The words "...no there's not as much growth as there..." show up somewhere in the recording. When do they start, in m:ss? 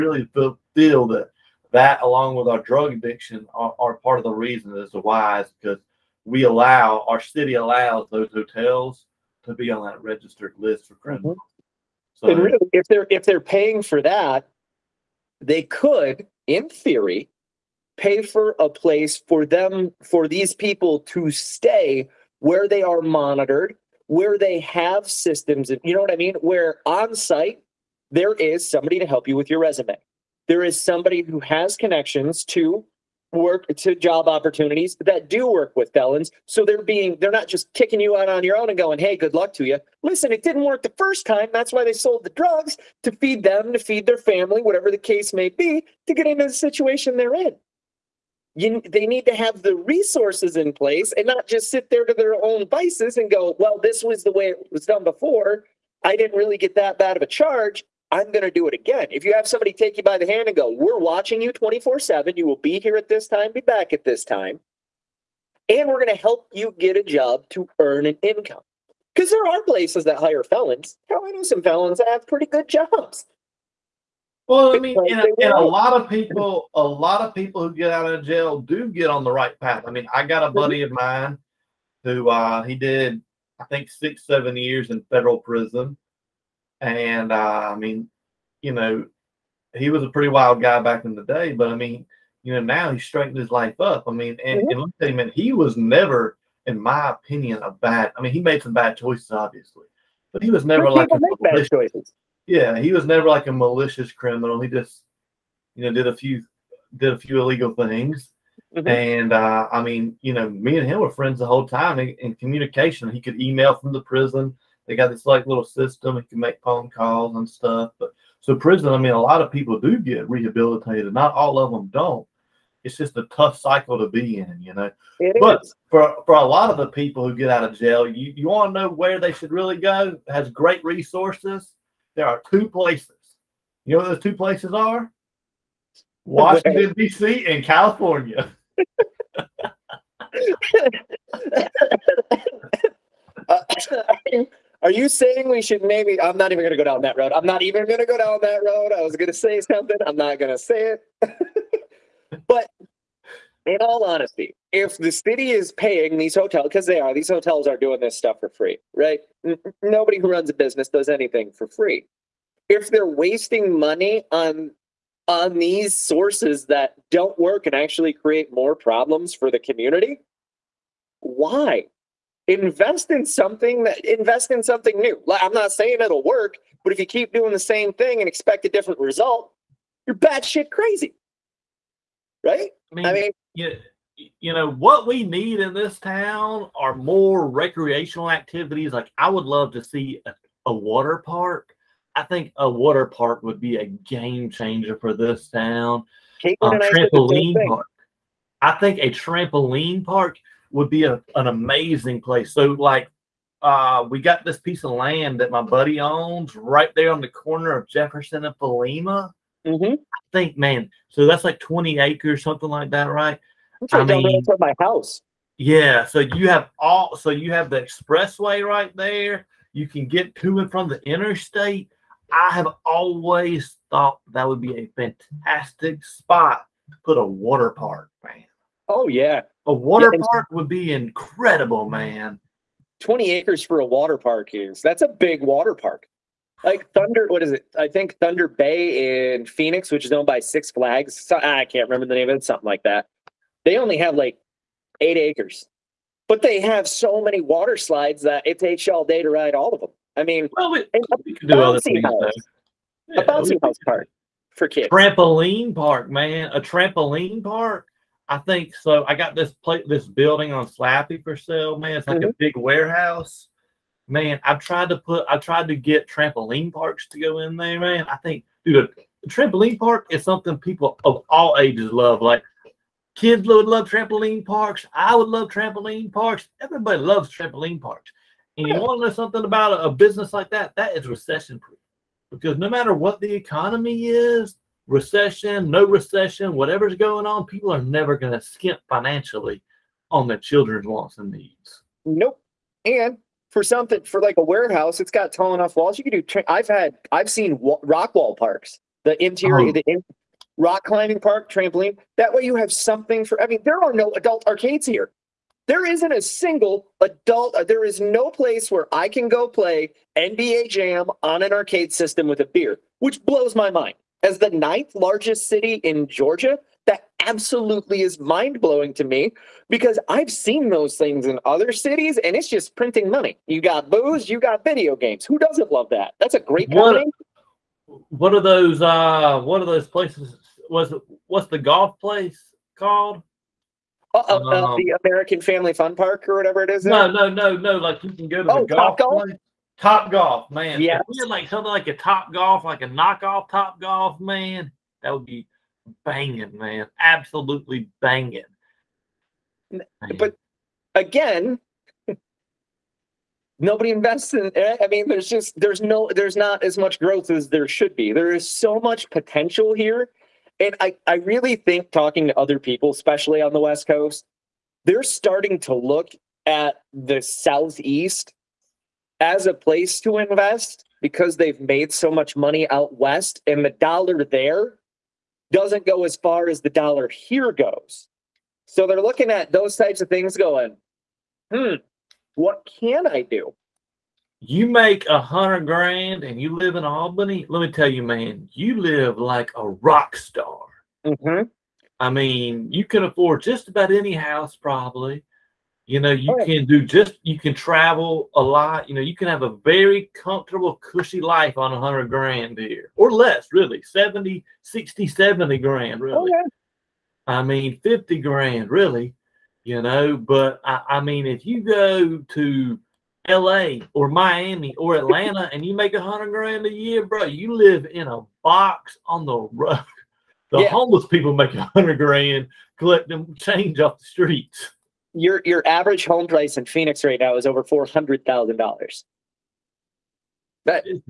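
5:55.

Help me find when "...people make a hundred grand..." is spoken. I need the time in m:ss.
7:01.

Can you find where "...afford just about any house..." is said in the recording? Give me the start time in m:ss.
6:33.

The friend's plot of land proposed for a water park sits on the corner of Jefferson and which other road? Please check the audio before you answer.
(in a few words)
Palmyra.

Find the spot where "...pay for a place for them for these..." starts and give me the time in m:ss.
0:17.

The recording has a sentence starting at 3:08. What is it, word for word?
Like I would love to see a, a water park.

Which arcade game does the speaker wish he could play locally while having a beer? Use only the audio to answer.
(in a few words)
NBA Jam.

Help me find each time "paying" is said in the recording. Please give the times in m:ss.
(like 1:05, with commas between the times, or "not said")
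0:13, 2:35.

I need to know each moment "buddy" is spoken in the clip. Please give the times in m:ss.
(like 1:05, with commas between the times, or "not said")
1:20, 3:25.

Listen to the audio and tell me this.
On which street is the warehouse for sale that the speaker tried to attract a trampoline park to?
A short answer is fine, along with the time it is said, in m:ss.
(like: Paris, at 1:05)
Slappey, at 4:20.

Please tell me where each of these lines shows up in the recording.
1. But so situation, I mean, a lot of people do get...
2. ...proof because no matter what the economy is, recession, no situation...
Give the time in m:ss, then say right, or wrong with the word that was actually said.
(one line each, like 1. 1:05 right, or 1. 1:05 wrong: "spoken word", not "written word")
1. 1:57 wrong: "prison", not "situation"
2. 4:41 wrong: "recession", not "situation".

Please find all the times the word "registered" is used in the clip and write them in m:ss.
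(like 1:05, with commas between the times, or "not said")
0:10.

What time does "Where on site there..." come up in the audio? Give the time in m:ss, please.
0:26.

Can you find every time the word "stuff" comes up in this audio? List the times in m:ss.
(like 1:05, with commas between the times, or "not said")
1:57, 2:38.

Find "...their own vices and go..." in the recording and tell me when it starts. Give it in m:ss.
0:52.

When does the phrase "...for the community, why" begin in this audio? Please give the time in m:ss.
2:49.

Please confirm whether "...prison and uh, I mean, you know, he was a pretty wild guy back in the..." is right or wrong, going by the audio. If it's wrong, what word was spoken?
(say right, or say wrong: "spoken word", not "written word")
right.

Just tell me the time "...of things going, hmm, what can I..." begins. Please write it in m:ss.
6:20.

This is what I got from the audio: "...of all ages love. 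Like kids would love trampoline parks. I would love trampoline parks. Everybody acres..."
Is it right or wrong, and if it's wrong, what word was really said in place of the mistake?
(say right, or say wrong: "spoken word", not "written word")
wrong: "loves", not "acres".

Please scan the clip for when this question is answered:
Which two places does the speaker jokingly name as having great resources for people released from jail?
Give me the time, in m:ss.
2:16.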